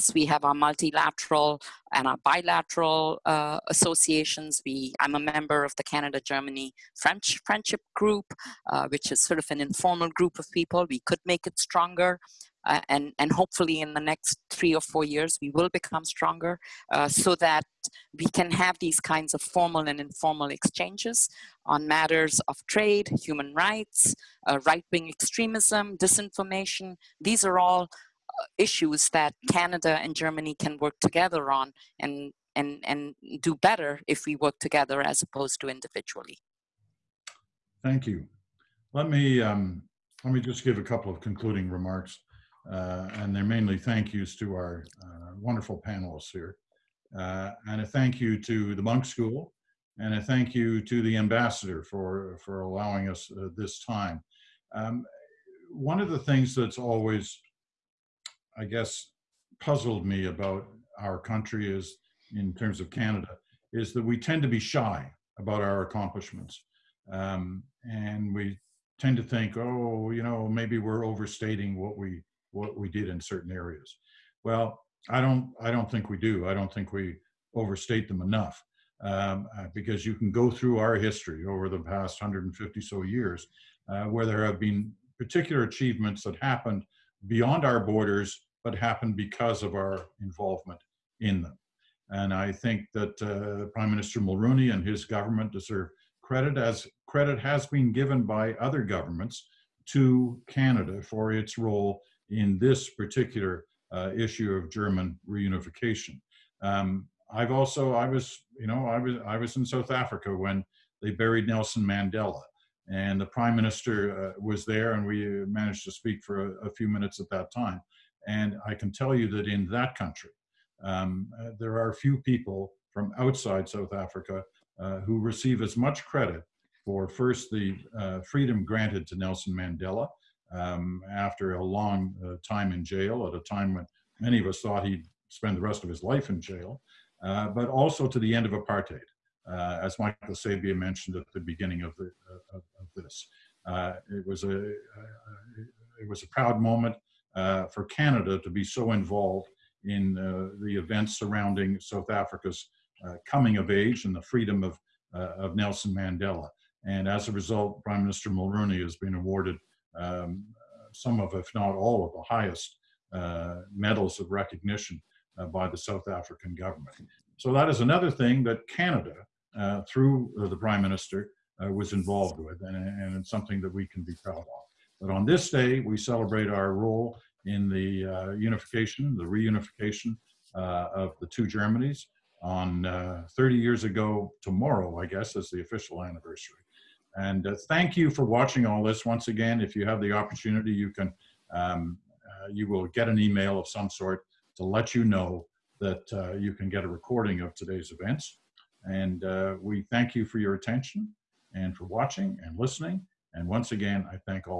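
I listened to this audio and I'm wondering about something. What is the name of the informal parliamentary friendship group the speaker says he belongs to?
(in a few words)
Canada Germany French Friendship Group.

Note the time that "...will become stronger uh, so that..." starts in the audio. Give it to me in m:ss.
0:15.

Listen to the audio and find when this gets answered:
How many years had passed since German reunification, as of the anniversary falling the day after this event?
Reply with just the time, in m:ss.
3:03.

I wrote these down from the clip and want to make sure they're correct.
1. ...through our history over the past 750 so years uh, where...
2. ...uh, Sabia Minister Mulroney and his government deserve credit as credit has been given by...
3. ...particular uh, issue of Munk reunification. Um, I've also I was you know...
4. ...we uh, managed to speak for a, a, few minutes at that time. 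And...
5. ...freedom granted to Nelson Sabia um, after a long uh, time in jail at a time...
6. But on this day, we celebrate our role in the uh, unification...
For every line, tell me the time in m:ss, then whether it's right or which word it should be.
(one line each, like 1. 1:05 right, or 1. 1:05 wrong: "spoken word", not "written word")
1. 1:20 wrong: "150", not "750"
2. 1:33 wrong: "Prime", not "Sabia"
3. 1:42 wrong: "German", not "Munk"
4. 1:55 right
5. 2:08 wrong: "Mandela", not "Sabia"
6. 2:54 right.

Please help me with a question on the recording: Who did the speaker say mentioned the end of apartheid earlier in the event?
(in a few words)
Michael Sabia.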